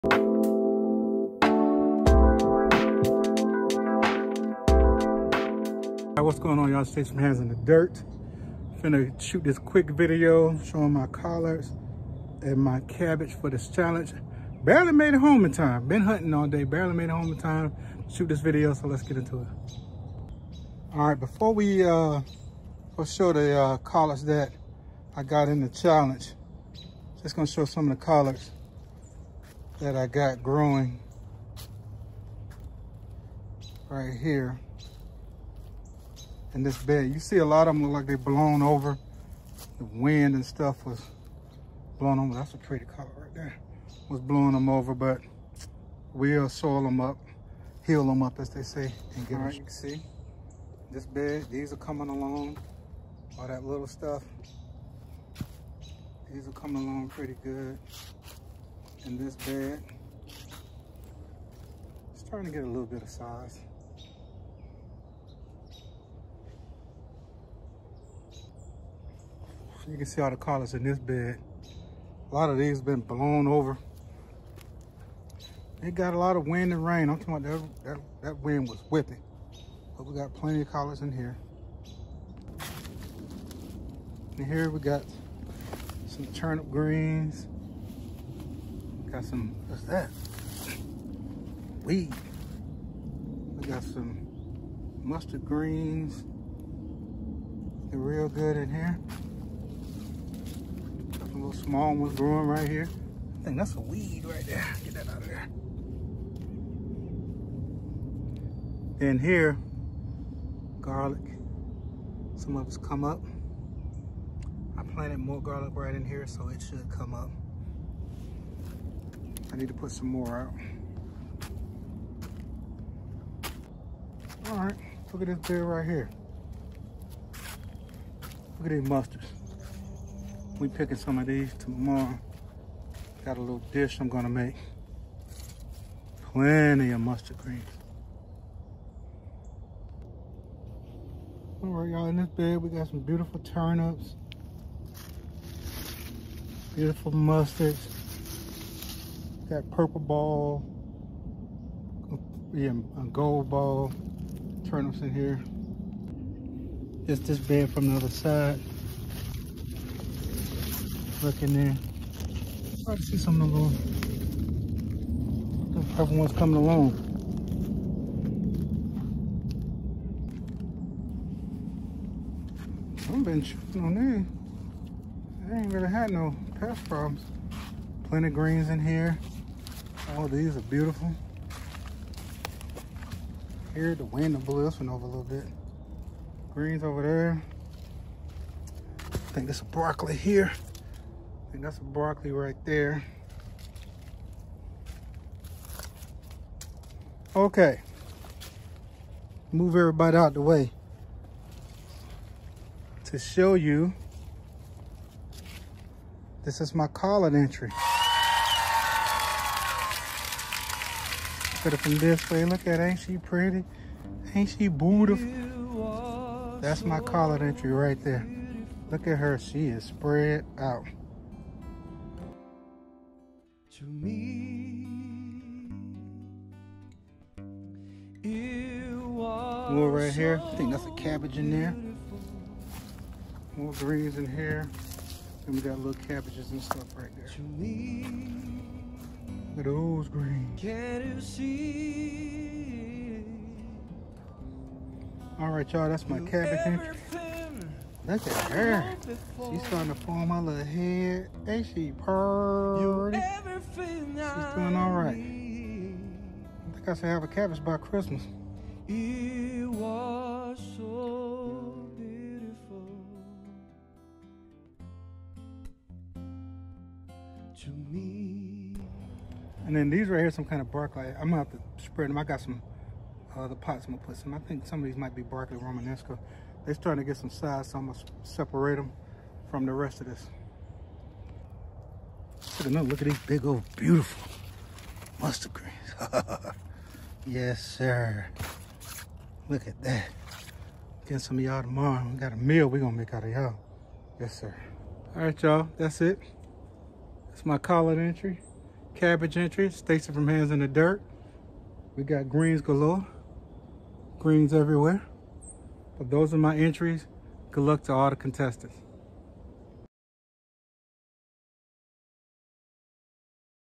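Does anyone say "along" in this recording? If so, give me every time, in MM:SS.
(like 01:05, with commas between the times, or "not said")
00:52, 00:56, 02:46.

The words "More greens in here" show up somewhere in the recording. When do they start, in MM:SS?
03:53.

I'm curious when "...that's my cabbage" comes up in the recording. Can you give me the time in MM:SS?
04:05.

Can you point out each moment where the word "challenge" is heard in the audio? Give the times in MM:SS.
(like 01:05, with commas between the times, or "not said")
00:13, 00:25.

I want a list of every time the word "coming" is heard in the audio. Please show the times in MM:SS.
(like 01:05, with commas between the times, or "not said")
00:51, 00:56, 02:46.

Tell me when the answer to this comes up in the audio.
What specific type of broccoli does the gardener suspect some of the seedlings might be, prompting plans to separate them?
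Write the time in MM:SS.
04:35.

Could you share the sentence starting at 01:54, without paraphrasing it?
I planted more garlic right in here, so it should come up.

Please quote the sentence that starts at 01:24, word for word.
And here we got some turnip greens.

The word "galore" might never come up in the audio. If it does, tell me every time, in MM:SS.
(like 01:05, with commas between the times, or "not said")
05:02.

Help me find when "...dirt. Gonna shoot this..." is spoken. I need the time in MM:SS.
00:07.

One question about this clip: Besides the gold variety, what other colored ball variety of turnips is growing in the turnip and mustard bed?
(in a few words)
Purple ball.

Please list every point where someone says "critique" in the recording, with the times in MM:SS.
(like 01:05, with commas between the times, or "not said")
not said.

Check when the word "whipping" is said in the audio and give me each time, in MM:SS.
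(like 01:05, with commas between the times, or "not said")
01:18.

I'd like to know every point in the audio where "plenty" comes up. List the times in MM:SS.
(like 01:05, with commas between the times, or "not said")
01:20, 02:16, 02:58.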